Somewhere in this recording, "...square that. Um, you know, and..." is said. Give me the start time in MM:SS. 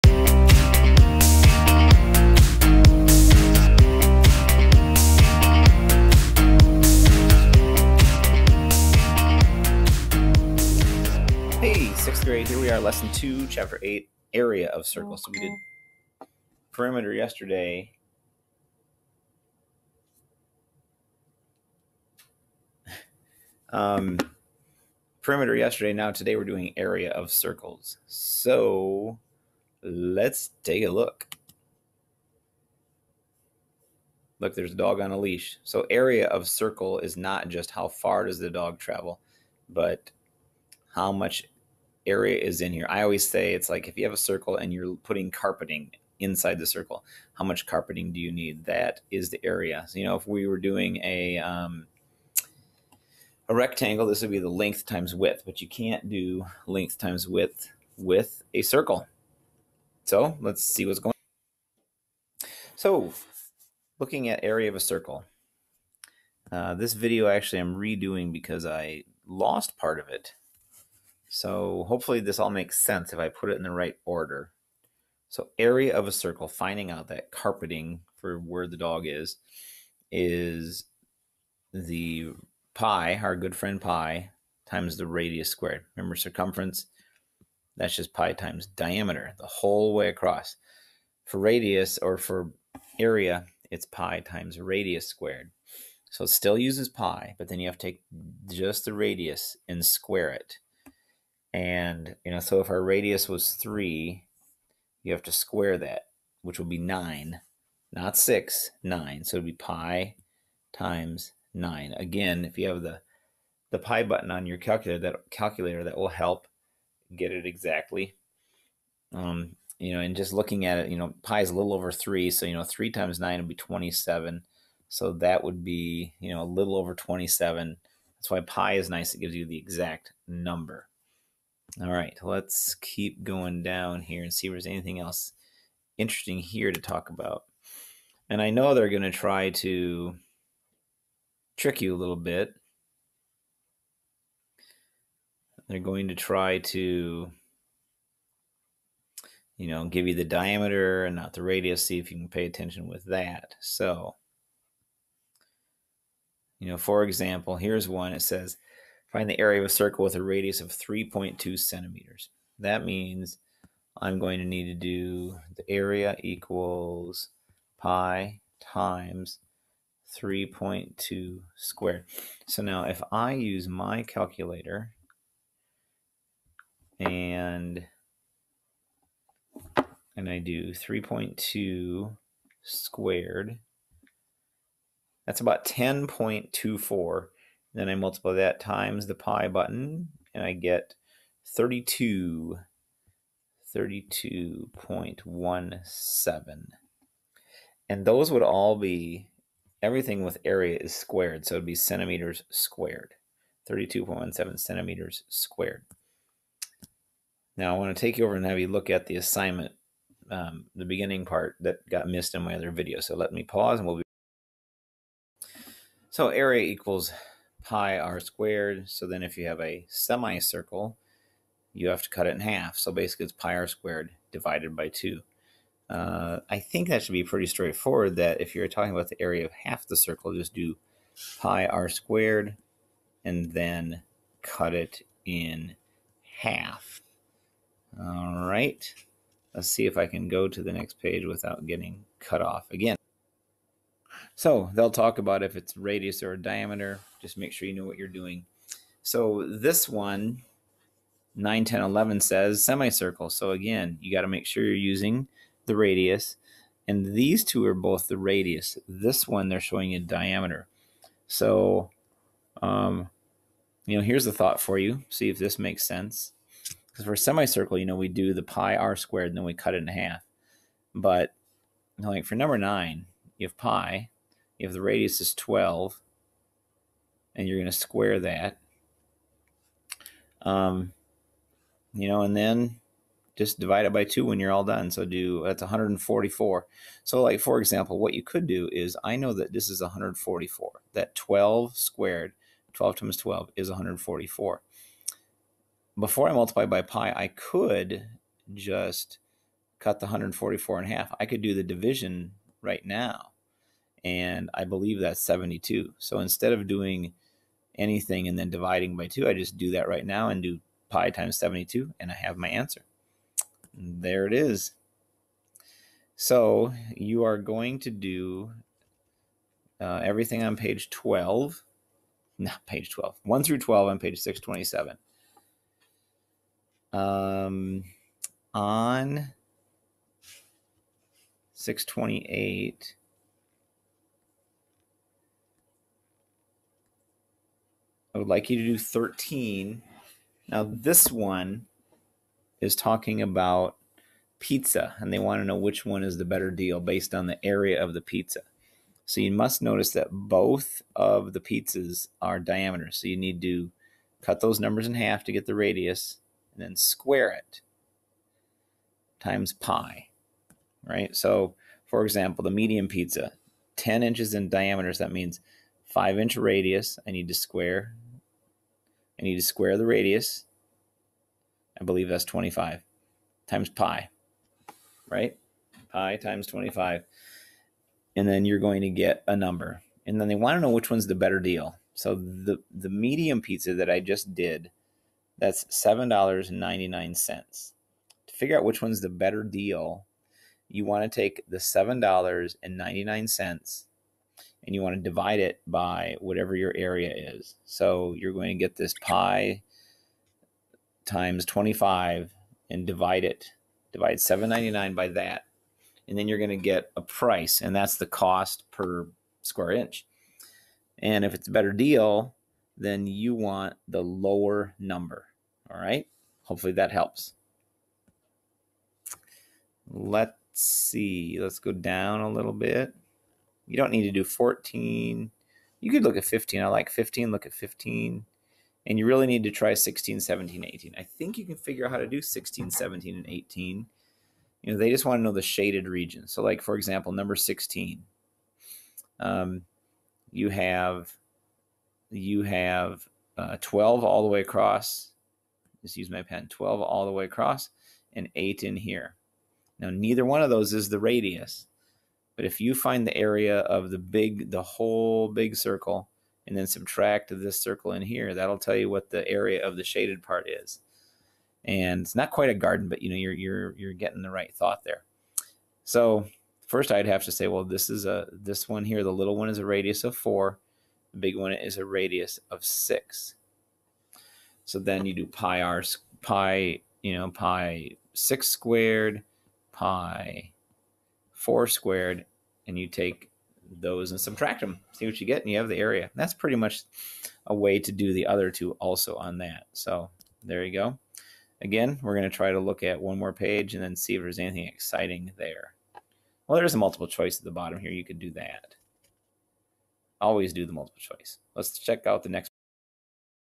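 04:37.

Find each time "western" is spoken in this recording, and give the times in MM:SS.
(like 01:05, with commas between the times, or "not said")
not said.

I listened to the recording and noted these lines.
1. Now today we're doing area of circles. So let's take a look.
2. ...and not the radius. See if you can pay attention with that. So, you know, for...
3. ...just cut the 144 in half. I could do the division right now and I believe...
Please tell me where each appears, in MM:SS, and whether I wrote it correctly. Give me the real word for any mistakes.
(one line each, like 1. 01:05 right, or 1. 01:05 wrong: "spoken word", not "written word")
1. 00:25 right
2. 02:31 right
3. 04:58 right.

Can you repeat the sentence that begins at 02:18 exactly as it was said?
And I know they're going to try to trick you a little bit.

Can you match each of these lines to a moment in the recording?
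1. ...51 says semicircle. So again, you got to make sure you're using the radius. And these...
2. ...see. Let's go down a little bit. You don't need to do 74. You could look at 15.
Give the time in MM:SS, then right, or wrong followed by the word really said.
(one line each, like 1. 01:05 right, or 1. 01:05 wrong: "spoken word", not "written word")
1. 04:11 wrong: "11", not "51"
2. 07:00 wrong: "14", not "74".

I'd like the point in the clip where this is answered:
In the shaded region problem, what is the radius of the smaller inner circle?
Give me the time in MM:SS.
07:50.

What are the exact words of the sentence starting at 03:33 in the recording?
So let me pause and we'll be.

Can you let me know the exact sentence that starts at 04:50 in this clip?
That 12 squared, 12 times 12 is 144.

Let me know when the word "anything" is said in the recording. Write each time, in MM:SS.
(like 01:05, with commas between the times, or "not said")
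02:14, 05:07, 08:14.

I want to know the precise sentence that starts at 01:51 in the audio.
Again, if you have the, the pi button on your calculator, that calculator, that will help get it exactly.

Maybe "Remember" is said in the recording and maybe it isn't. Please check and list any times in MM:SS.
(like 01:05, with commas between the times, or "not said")
01:25.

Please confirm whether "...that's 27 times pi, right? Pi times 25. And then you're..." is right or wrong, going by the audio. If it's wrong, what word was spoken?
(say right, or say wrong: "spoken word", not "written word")
wrong: "25", not "27".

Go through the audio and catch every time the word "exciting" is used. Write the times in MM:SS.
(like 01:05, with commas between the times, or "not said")
08:14.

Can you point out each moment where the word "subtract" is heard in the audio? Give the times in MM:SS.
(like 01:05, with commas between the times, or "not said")
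07:36, 08:04.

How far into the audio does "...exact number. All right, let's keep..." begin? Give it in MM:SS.
02:09.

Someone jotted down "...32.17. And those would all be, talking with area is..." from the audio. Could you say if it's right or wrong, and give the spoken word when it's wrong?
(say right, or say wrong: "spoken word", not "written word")
wrong: "everything", not "talking".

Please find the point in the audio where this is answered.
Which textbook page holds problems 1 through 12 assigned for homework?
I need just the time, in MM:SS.
05:24.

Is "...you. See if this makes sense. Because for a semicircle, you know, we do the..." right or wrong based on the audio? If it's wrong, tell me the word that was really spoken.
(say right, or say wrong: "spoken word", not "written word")
right.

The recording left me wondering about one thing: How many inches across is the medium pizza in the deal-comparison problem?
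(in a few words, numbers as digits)
10 inches.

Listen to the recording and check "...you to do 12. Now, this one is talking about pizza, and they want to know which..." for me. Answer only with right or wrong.
wrong.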